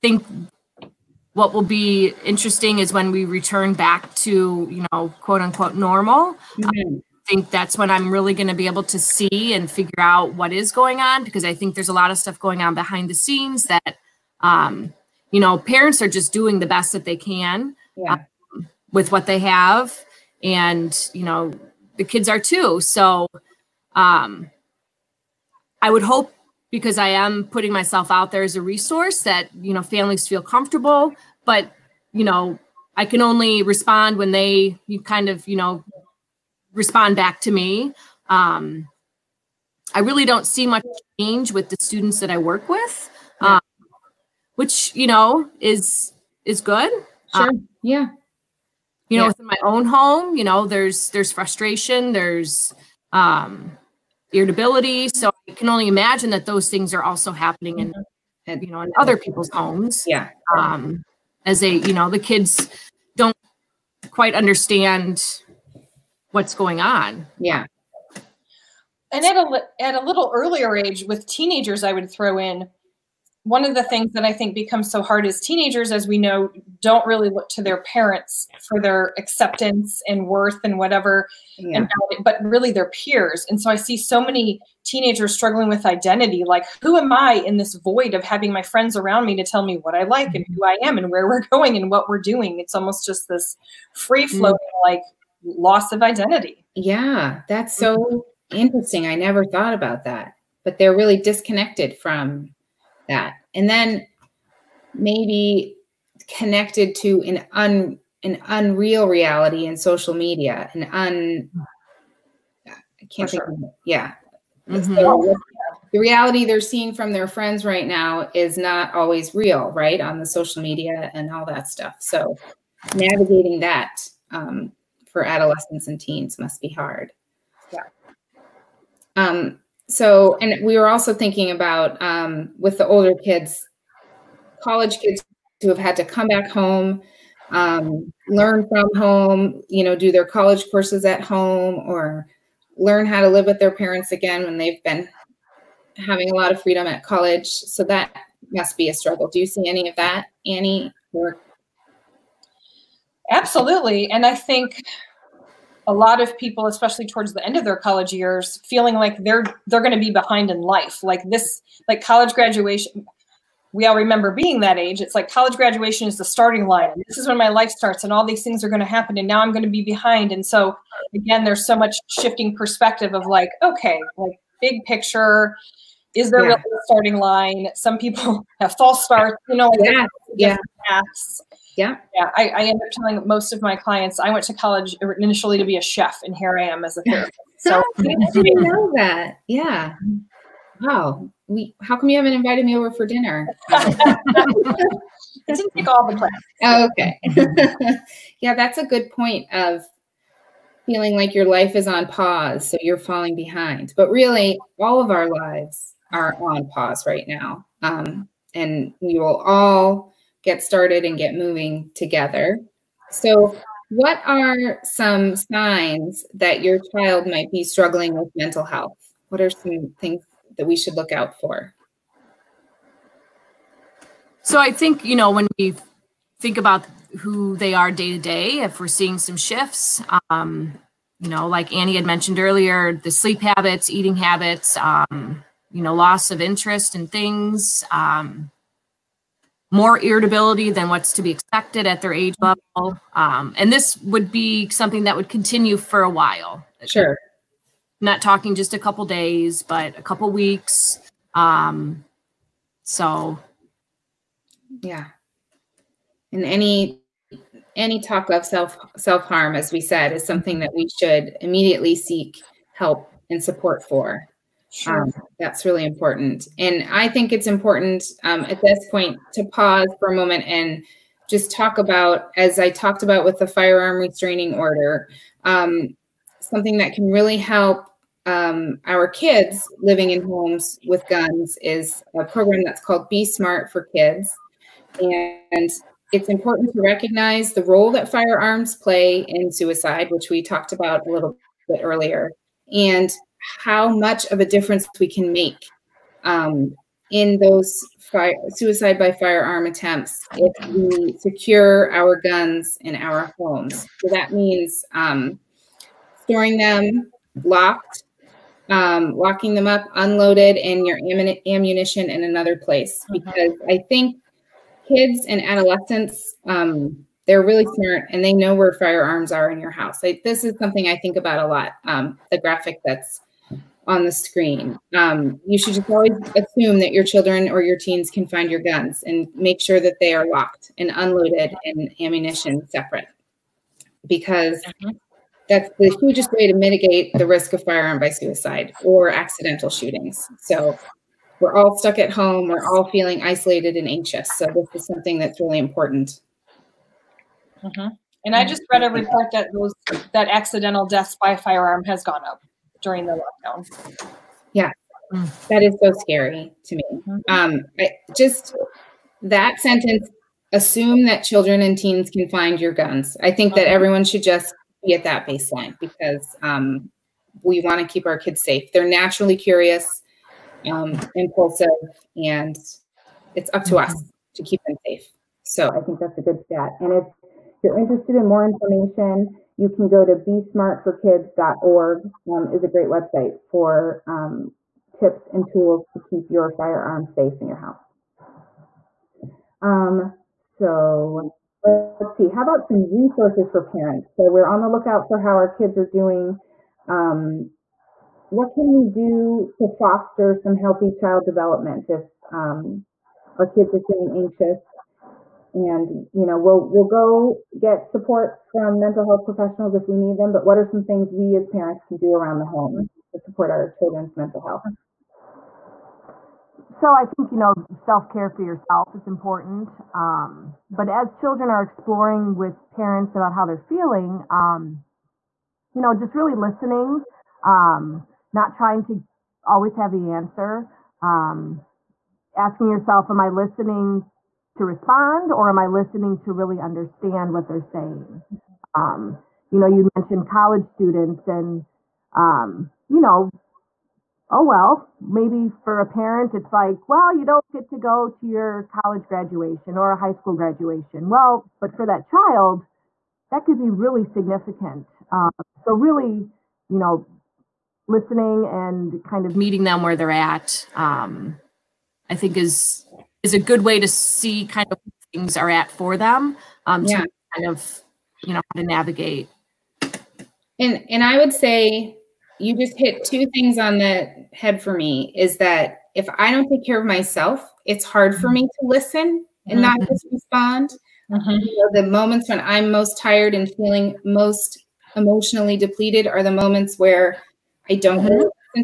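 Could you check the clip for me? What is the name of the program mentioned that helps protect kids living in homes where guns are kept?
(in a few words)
Be Smart for Kids.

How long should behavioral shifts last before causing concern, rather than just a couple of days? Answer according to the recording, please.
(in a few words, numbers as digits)
A couple weeks.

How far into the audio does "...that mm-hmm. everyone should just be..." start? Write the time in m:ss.
6:03.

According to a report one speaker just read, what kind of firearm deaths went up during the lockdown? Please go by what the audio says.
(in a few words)
Accidental deaths.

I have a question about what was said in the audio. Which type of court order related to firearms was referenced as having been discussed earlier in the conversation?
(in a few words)
Firearm restraining order.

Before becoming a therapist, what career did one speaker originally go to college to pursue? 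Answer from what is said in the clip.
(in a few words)
Chef.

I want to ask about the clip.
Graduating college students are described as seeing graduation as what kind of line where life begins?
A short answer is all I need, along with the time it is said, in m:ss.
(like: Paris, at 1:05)
The starting line, at 2:46.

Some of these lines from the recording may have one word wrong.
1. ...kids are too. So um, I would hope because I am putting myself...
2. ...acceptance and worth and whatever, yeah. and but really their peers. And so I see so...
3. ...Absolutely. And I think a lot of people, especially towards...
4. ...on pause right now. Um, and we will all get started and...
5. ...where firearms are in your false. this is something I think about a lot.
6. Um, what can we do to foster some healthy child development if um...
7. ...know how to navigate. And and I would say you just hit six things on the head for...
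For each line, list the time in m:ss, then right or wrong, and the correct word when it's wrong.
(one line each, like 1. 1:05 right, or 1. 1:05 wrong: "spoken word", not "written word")
1. 0:22 right
2. 1:19 right
3. 2:33 right
4. 3:26 right
5. 5:18 wrong: "house", not "false"
6. 6:36 right
7. 7:48 wrong: "two", not "six".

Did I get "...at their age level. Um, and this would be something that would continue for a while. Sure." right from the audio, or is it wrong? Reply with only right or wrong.
right.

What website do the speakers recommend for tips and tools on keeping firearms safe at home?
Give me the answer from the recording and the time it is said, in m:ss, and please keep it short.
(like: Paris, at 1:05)
besmartforkids.org, at 6:20.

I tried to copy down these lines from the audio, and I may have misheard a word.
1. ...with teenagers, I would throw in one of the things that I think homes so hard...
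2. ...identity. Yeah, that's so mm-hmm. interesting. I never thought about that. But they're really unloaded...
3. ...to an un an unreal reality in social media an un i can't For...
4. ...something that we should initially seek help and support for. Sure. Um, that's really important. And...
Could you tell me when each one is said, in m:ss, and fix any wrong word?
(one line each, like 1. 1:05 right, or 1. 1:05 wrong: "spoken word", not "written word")
1. 1:11 wrong: "becomes", not "homes"
2. 1:36 wrong: "disconnected", not "unloaded"
3. 1:46 right
4. 4:20 wrong: "immediately", not "initially".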